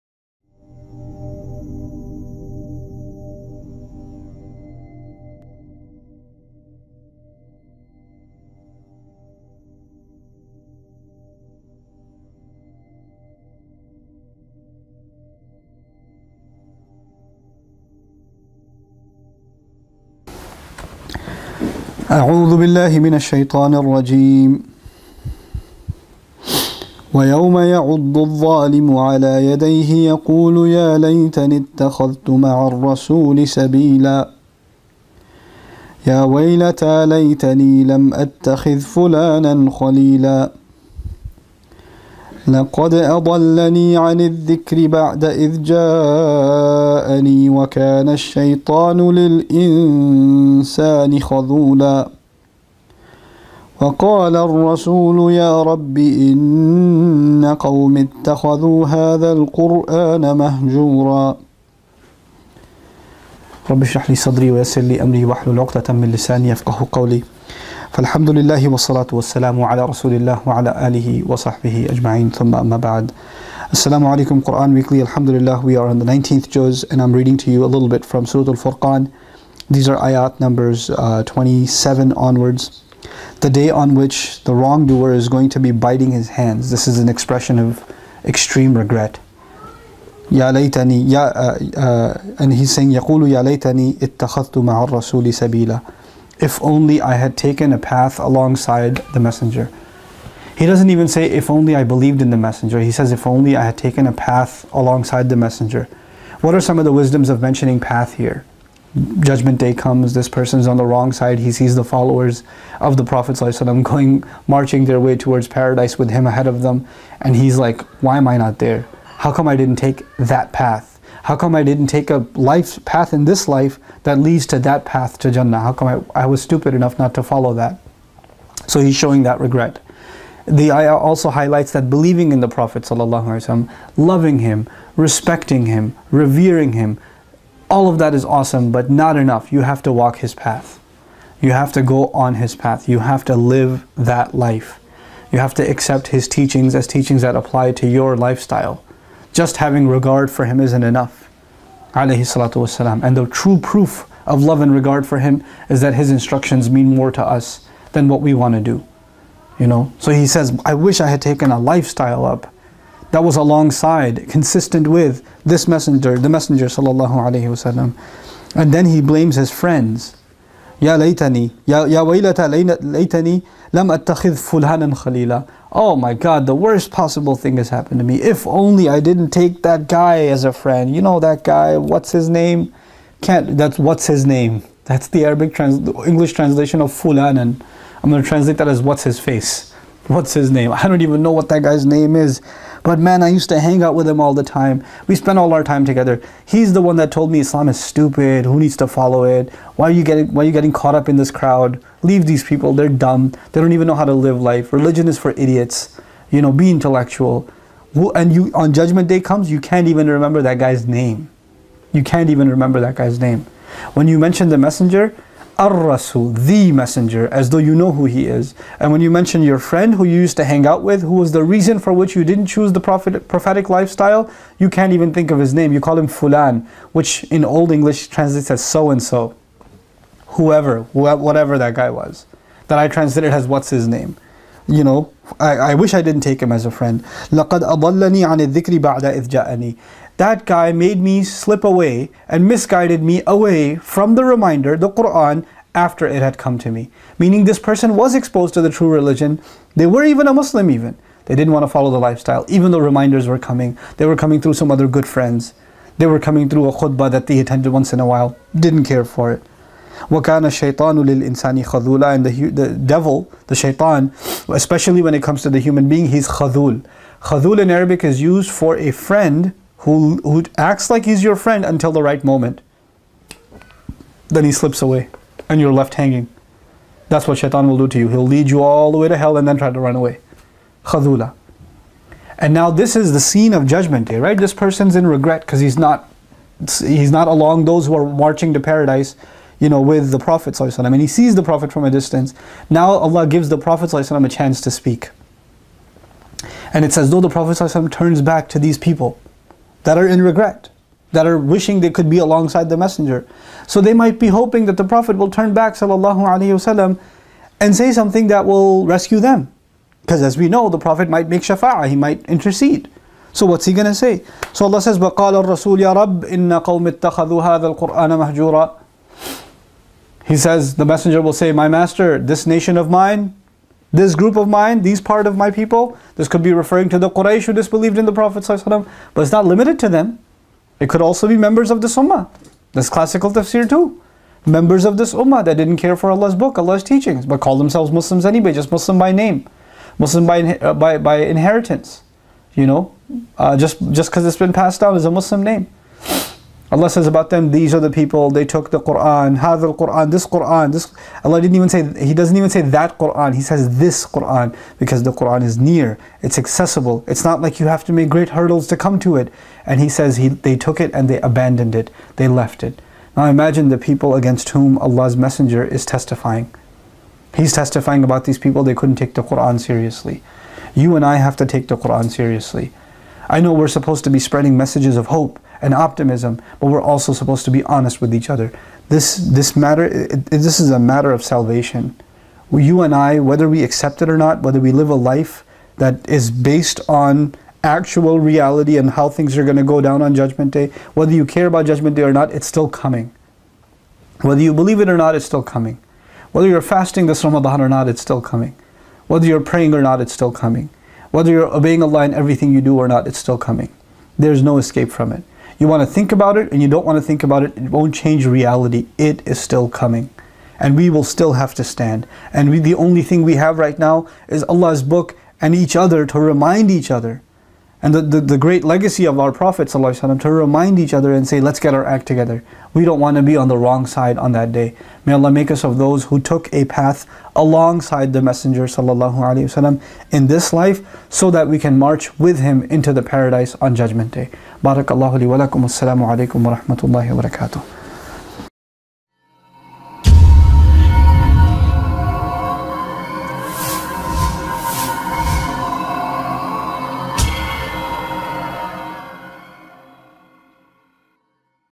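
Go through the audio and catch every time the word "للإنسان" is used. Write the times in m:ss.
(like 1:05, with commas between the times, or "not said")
0:49, 4:21.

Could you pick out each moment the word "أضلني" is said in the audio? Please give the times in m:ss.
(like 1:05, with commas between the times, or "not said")
0:42, 3:57.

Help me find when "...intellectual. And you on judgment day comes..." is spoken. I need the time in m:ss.
3:26.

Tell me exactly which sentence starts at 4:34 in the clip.
Then he slips away and you're left hanging.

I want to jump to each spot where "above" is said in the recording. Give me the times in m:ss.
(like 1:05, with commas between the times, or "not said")
not said.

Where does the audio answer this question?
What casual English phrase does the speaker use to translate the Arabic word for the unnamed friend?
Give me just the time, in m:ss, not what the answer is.
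3:08.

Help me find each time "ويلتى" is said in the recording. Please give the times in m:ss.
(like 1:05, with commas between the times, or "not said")
0:36, 2:52.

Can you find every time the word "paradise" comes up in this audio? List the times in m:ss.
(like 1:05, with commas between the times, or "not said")
1:55, 4:48, 7:13.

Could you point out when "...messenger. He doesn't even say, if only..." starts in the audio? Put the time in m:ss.
1:39.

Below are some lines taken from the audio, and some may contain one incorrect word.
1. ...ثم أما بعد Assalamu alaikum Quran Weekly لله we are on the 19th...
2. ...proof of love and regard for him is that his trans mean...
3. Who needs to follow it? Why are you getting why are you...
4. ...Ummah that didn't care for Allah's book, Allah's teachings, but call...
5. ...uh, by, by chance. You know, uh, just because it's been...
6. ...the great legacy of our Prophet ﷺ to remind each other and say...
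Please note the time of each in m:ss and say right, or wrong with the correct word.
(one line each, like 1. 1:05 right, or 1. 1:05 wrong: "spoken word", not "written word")
1. 1:12 right
2. 2:33 wrong: "instructions", not "trans"
3. 3:18 right
4. 5:35 right
5. 5:40 wrong: "inheritance", not "chance"
6. 6:58 right.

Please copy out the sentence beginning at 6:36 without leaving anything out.
Whether you're fasting this Ramadan or not, it's still coming.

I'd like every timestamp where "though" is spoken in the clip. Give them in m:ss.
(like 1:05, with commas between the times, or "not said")
3:37, 4:12, 4:57.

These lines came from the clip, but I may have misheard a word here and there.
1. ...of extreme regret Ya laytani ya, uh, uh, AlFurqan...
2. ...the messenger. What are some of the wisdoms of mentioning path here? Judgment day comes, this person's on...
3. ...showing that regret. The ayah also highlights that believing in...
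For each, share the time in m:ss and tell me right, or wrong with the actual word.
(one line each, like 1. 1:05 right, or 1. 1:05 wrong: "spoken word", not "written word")
1. 1:27 wrong: "And", not "AlFurqan"
2. 1:45 right
3. 2:08 right.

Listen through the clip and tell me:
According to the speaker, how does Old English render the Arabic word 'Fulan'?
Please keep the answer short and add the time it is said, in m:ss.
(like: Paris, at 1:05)
so-and-so, at 3:48.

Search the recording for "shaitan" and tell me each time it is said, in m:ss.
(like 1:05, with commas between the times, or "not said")
4:23, 4:37.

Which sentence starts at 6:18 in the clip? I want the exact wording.
This, this matter, it, it, this is a matter of salvation.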